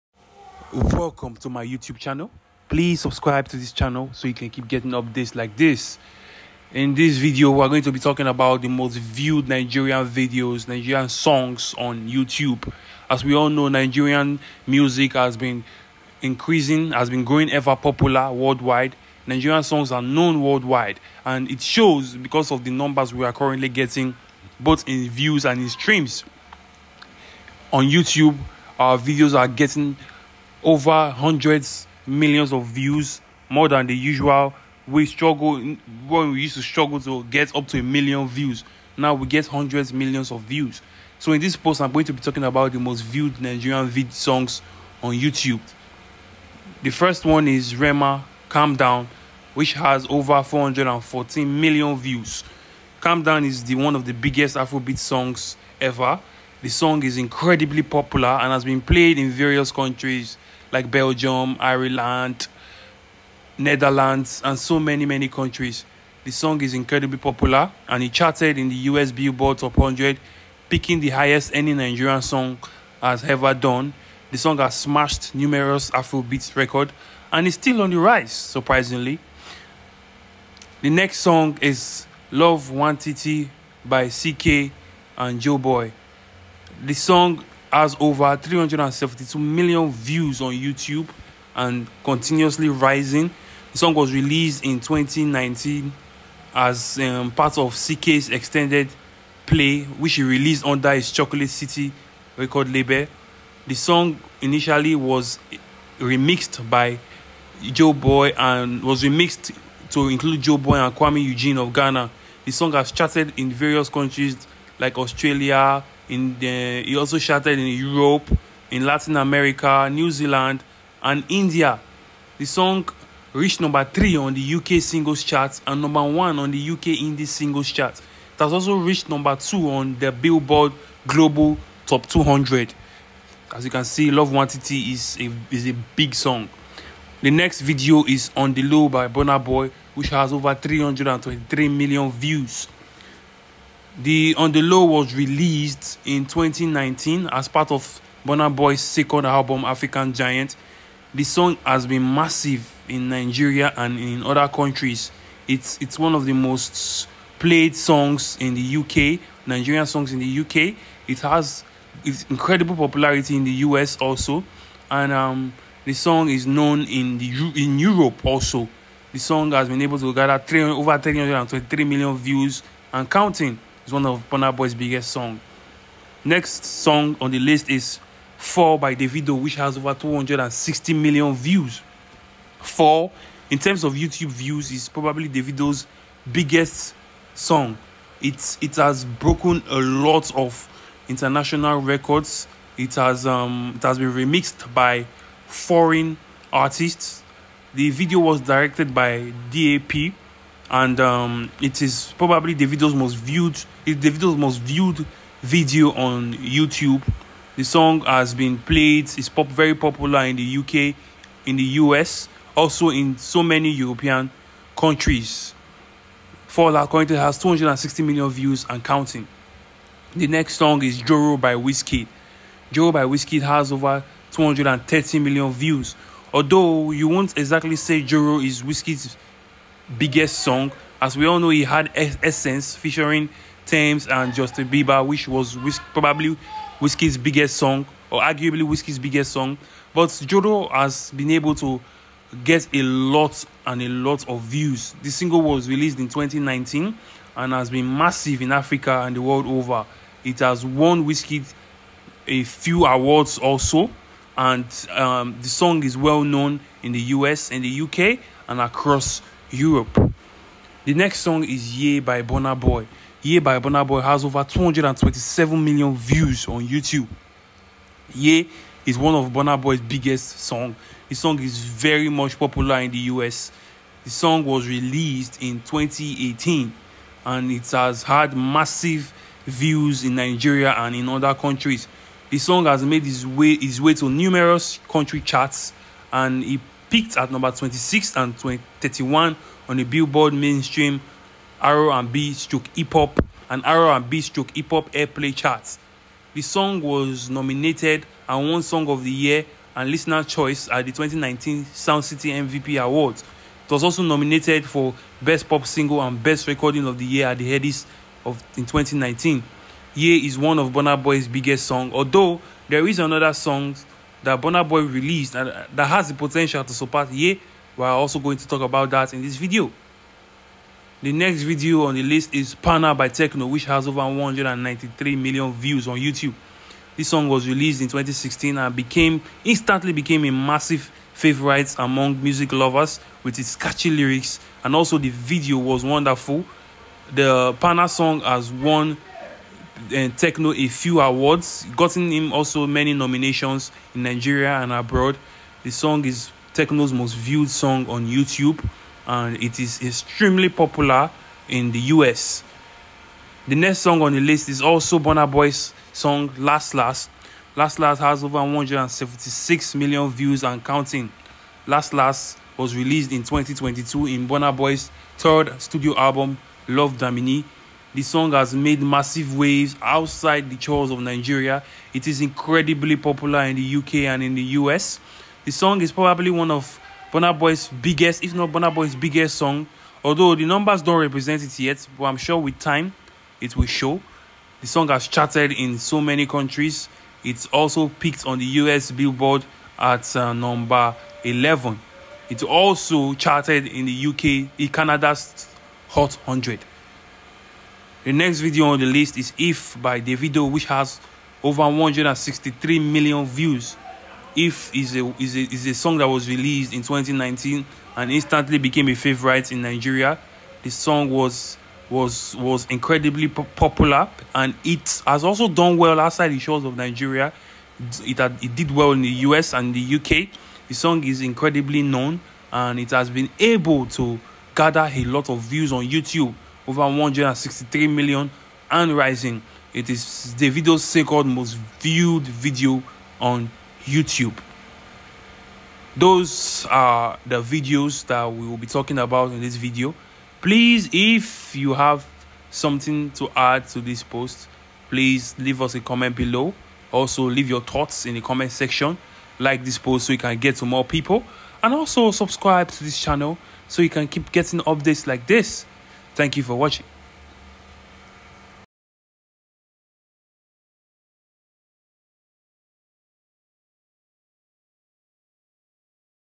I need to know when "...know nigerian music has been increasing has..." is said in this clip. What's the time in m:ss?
0:13.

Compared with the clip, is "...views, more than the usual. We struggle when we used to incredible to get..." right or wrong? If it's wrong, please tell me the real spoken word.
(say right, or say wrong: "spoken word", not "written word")
wrong: "struggle", not "incredible".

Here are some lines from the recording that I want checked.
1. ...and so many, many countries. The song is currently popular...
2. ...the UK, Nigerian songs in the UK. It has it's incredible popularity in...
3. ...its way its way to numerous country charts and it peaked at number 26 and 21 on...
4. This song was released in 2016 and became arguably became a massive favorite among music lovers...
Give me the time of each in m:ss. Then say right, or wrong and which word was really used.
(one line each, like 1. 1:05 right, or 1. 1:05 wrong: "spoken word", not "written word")
1. 1:04 wrong: "incredibly", not "currently"
2. 2:38 right
3. 4:43 wrong: "31", not "21"
4. 5:26 wrong: "instantly", not "arguably".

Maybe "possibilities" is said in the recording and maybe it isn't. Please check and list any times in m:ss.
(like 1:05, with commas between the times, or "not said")
not said.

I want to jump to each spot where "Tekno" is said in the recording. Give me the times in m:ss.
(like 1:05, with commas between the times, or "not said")
5:23, 5:40, 5:46.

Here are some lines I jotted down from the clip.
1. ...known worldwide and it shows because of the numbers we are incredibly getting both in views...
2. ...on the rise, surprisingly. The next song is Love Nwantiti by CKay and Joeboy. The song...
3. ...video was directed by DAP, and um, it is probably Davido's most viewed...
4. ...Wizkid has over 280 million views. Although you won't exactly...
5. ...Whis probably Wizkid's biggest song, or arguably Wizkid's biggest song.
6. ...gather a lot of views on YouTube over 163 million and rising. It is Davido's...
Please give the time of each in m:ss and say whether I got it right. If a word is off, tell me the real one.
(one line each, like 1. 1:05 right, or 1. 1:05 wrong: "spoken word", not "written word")
1. 0:20 wrong: "currently", not "incredibly"
2. 1:17 right
3. 3:17 right
4. 3:43 wrong: "230", not "280"
5. 3:55 right
6. 7:04 right.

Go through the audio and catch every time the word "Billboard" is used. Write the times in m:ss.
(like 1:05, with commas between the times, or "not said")
1:09, 2:10, 4:49, 6:28.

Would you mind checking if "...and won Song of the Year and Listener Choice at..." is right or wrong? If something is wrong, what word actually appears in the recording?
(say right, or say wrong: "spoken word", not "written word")
right.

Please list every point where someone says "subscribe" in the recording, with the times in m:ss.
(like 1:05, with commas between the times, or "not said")
0:03, 7:32.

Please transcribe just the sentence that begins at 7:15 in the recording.
Those are the videos that we will be talking about in this video.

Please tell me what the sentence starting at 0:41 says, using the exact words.
So in this post, I'm going to be talking about the most viewed Nigerian vid songs on YouTube.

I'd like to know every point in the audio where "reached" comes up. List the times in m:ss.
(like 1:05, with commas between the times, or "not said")
2:03, 2:08.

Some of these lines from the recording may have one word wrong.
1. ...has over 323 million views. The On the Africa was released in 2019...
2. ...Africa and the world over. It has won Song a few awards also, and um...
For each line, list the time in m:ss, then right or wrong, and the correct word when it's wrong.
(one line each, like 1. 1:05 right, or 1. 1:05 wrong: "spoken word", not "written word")
1. 2:20 wrong: "Low", not "Africa"
2. 4:08 wrong: "Wizkid", not "Song".